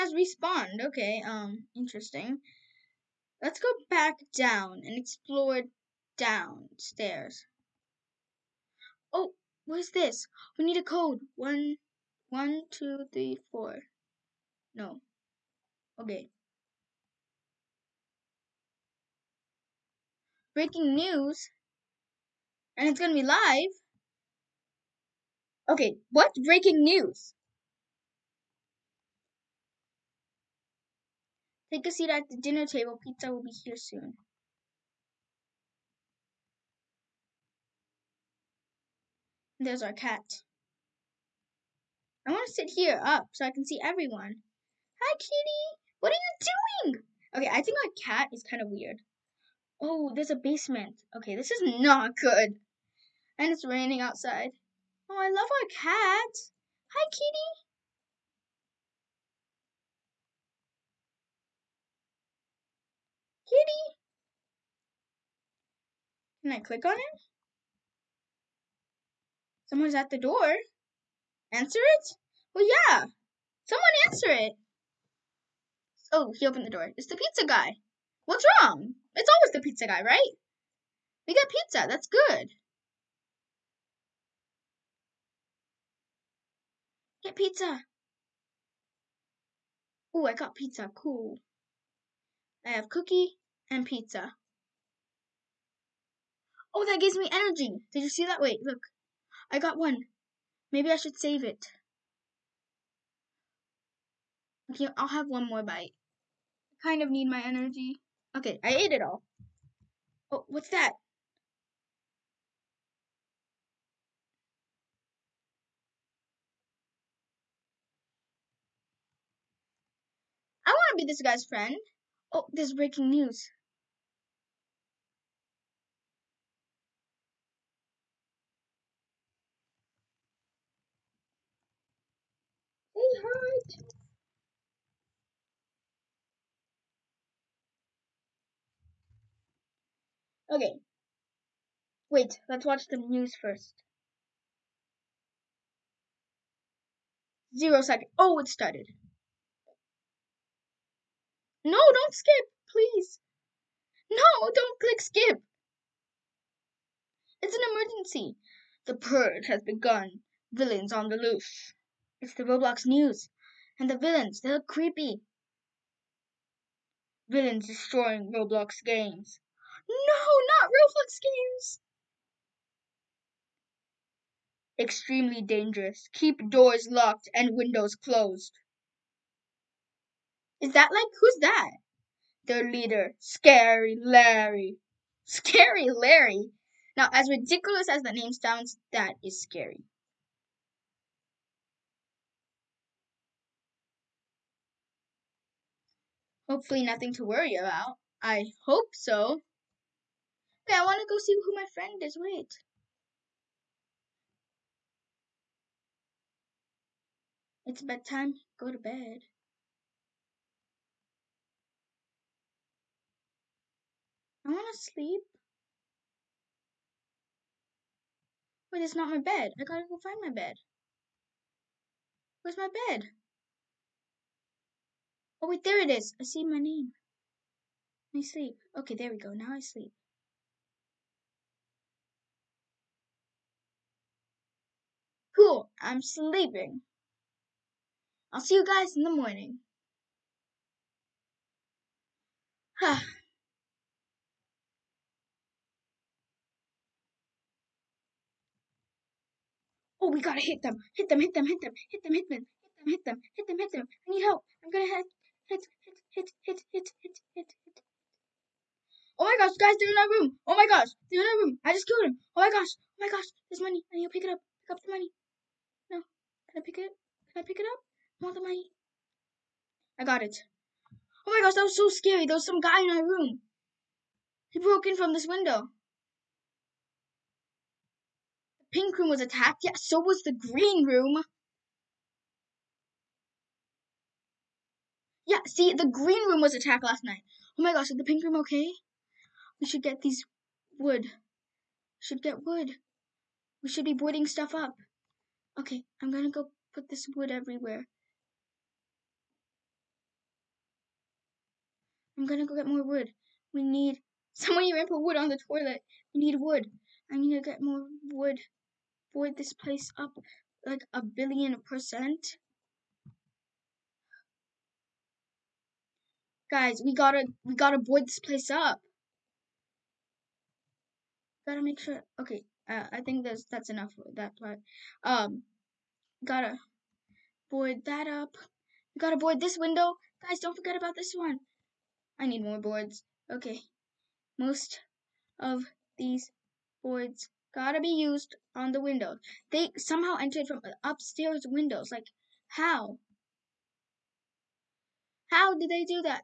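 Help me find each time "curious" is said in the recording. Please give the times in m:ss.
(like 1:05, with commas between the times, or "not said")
not said.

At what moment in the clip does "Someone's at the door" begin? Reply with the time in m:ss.
1:09.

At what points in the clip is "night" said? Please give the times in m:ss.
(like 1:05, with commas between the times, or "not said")
4:47.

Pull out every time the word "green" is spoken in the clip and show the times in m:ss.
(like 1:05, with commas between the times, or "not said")
4:40, 4:45.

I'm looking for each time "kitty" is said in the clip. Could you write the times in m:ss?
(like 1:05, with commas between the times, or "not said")
0:45, 0:57, 1:03.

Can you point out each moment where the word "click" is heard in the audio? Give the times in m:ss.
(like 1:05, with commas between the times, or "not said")
1:06, 2:34.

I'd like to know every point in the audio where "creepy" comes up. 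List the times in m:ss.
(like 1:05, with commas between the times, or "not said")
2:44.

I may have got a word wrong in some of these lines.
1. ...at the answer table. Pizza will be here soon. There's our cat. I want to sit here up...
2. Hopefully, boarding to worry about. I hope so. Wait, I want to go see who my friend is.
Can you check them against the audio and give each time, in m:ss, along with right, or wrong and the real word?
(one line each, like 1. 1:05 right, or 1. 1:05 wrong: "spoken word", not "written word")
1. 0:32 wrong: "dinner", not "answer"
2. 3:16 wrong: "nothing", not "boarding".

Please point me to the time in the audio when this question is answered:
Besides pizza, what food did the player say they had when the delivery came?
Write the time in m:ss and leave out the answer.
1:32.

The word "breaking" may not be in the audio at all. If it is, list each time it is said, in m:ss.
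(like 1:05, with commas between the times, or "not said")
0:20, 0:26, 2:02.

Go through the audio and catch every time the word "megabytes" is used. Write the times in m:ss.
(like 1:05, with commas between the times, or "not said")
not said.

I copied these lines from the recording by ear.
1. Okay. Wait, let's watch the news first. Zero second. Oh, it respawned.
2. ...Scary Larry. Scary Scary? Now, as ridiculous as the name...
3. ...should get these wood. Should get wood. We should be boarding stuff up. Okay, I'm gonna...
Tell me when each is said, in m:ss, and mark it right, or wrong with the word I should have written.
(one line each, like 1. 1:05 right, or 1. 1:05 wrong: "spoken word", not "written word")
1. 2:20 wrong: "started", not "respawned"
2. 3:03 wrong: "Larry", not "Scary"
3. 4:49 right.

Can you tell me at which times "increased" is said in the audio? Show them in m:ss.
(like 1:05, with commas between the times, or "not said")
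not said.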